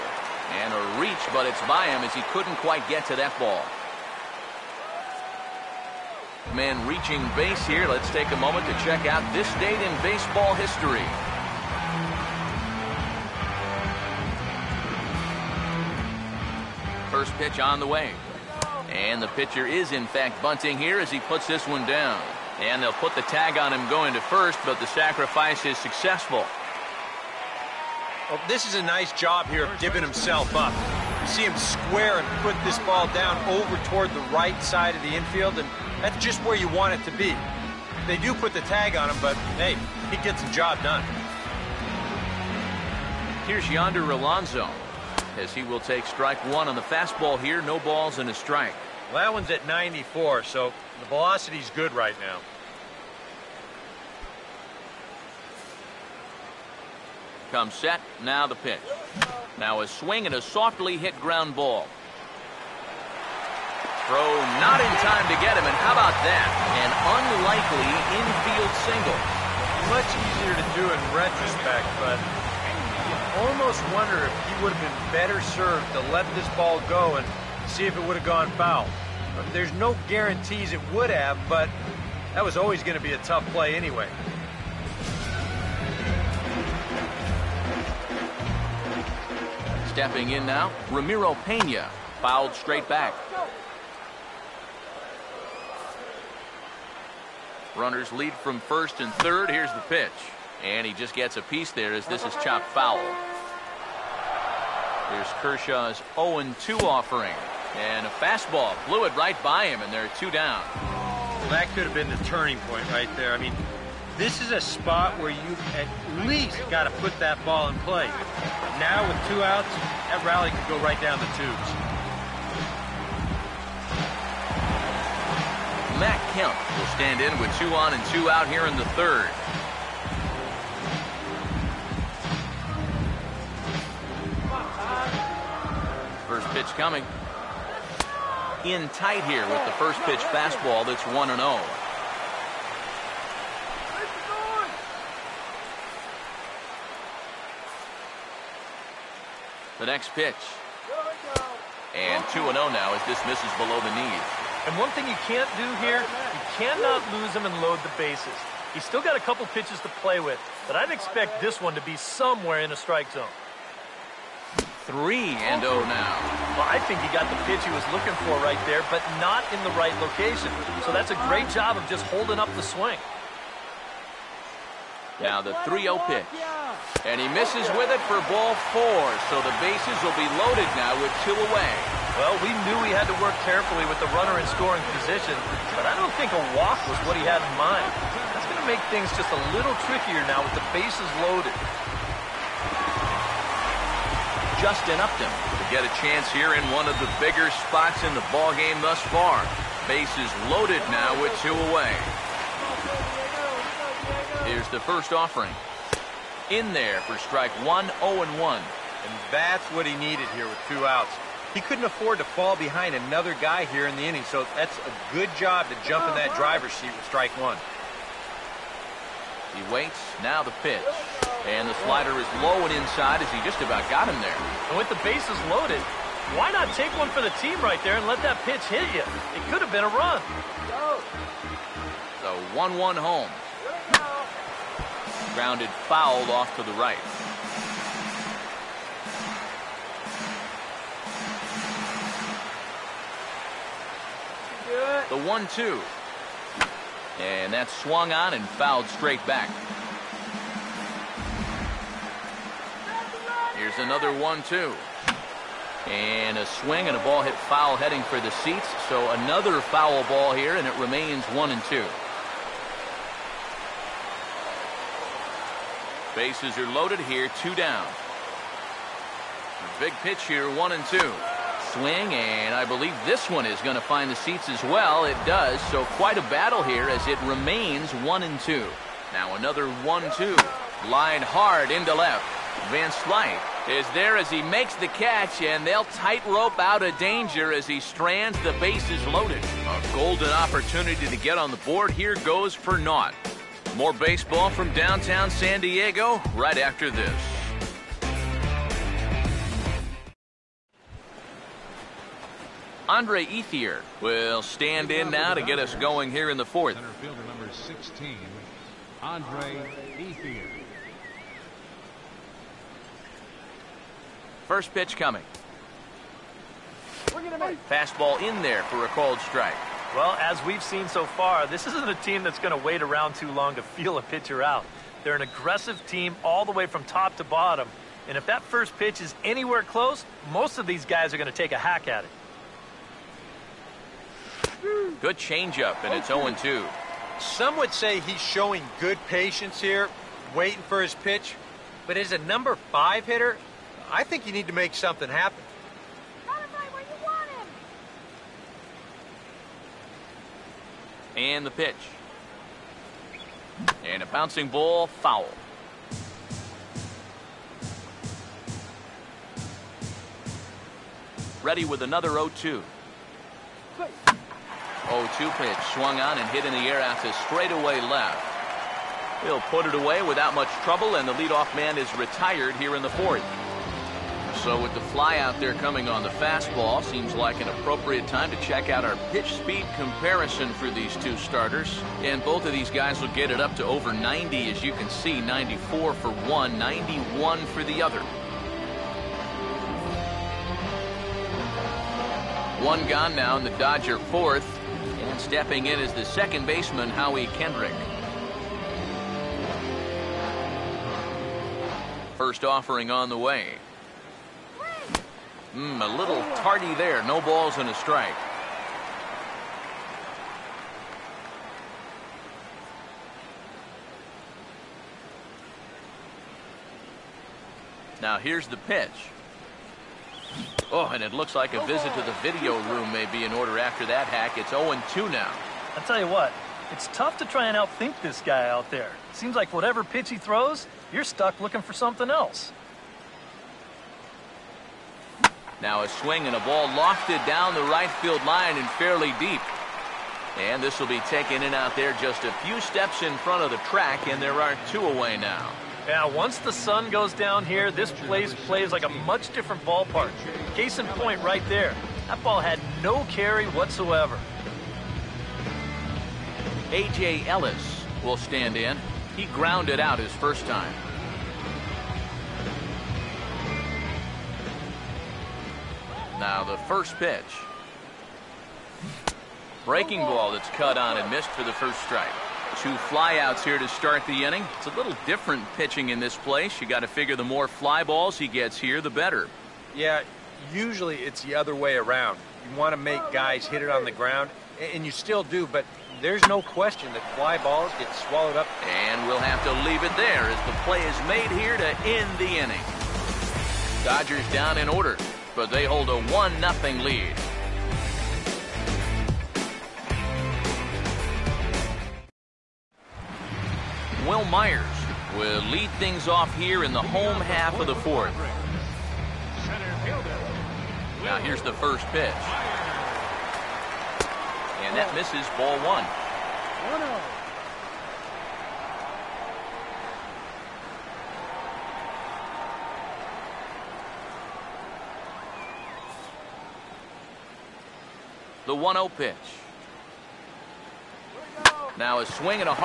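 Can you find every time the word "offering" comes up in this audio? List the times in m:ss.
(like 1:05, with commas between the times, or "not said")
1:46, 3:25, 6:42.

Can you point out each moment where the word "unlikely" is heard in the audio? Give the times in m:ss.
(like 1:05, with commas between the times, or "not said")
1:07.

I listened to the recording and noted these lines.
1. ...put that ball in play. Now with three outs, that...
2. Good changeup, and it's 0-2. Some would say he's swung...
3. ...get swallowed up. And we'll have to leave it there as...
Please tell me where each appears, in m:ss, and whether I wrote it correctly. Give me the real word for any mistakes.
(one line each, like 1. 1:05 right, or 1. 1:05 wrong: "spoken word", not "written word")
1. 1:57 wrong: "two", not "three"
2. 5:35 wrong: "showing", not "swung"
3. 8:07 right.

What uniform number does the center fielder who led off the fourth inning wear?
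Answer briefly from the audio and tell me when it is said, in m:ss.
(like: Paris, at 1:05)
16, at 5:07.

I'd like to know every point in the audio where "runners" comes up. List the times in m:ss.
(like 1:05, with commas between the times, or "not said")
1:37, 3:04.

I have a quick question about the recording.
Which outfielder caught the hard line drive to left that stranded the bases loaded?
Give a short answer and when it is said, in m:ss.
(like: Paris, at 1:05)
Van Slyke, at 4:42.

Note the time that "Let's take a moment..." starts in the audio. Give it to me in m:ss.
0:07.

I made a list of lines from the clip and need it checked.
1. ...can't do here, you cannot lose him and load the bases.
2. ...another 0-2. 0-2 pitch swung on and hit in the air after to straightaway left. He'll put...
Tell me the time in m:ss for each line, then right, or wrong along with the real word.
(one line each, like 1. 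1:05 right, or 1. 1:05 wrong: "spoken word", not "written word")
1. 2:35 right
2. 6:01 right.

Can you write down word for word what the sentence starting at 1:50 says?
Well, that could have been the turning point right there.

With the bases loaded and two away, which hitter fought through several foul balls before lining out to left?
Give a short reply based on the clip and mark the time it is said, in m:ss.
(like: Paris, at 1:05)
Justin Upton, at 3:14.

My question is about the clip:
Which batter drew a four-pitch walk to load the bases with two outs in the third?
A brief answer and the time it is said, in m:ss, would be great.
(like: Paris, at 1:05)
Matt Kemp, at 2:05.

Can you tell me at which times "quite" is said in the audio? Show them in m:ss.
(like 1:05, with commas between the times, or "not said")
0:02, 4:35.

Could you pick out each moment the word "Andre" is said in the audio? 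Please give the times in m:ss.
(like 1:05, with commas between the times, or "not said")
5:02, 5:09.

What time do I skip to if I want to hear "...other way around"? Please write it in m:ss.
8:01.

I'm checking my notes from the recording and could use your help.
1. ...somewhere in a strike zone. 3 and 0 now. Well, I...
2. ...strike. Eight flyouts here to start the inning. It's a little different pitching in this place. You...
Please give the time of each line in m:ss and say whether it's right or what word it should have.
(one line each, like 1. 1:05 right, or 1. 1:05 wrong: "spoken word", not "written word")
1. 2:41 right
2. 7:51 wrong: "Two", not "Eight".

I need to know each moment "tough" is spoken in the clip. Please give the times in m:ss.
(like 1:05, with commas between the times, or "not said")
1:23, 7:06.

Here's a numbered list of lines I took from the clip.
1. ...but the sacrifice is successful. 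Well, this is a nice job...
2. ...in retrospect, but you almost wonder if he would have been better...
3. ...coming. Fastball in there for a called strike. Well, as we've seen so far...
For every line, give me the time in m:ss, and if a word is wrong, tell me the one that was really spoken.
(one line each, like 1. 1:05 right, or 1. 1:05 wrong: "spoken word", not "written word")
1. 0:24 right
2. 1:10 right
3. 5:14 right.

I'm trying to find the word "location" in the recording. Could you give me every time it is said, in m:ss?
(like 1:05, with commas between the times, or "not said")
2:49.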